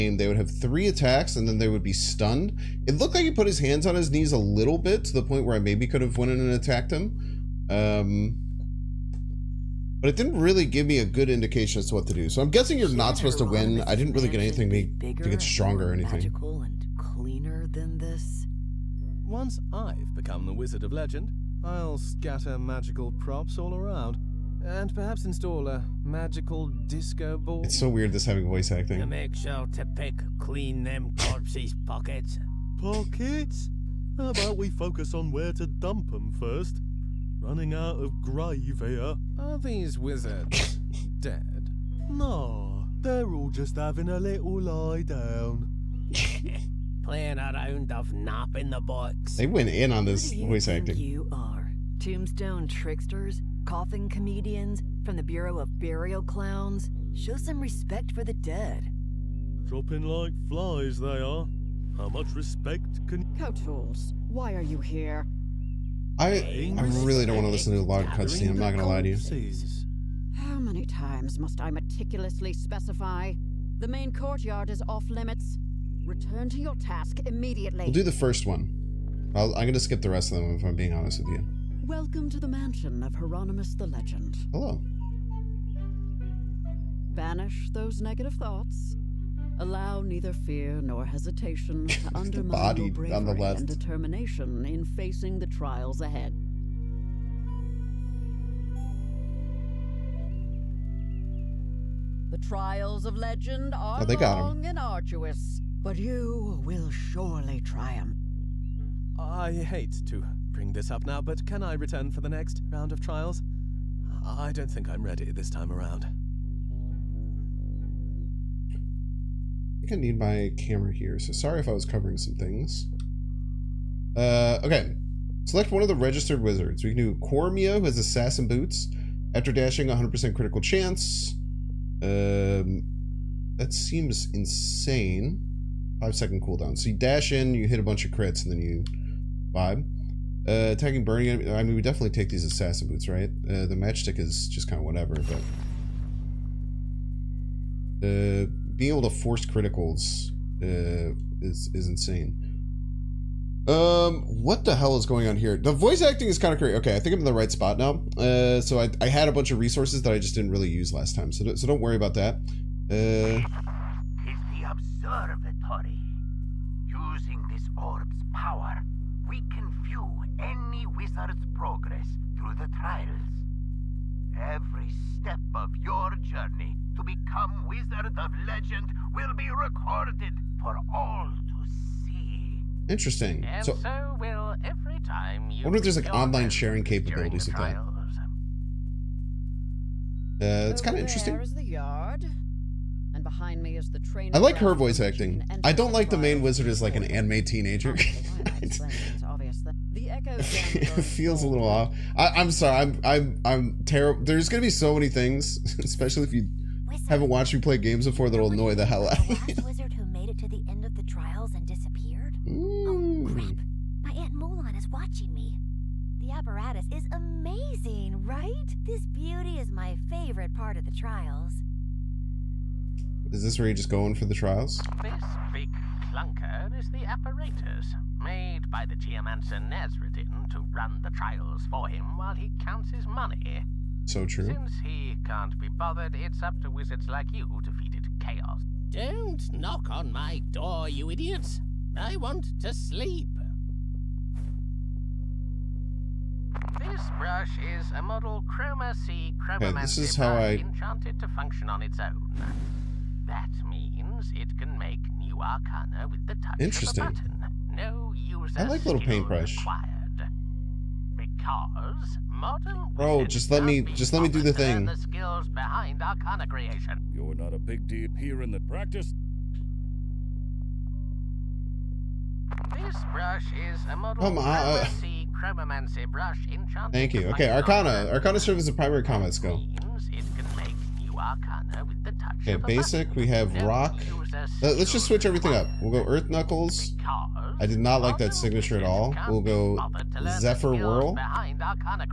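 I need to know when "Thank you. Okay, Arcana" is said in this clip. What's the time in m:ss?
4:36.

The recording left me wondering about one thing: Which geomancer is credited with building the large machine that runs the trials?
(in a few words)
Nazreddin.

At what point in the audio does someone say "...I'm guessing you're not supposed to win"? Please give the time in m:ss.
0:12.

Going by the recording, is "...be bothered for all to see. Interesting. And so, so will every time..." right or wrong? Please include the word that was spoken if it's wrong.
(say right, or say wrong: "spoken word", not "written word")
wrong: "recorded", not "bothered".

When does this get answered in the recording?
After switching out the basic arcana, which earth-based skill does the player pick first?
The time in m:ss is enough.
4:46.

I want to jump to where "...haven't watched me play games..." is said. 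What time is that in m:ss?
3:27.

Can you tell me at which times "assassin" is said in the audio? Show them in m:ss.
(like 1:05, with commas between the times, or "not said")
2:07, 2:22.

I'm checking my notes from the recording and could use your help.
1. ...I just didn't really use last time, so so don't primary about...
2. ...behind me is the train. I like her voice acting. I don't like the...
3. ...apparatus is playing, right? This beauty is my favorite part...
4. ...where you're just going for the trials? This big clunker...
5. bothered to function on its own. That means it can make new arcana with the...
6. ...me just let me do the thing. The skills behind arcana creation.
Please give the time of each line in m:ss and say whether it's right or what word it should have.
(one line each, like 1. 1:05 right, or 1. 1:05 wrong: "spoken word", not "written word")
1. 2:40 wrong: "worry", not "primary"
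2. 3:13 right
3. 3:36 wrong: "amazing", not "playing"
4. 3:43 right
5. 4:10 wrong: "enchanted", not "bothered"
6. 4:23 right.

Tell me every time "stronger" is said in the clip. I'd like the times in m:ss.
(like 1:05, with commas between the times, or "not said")
0:15.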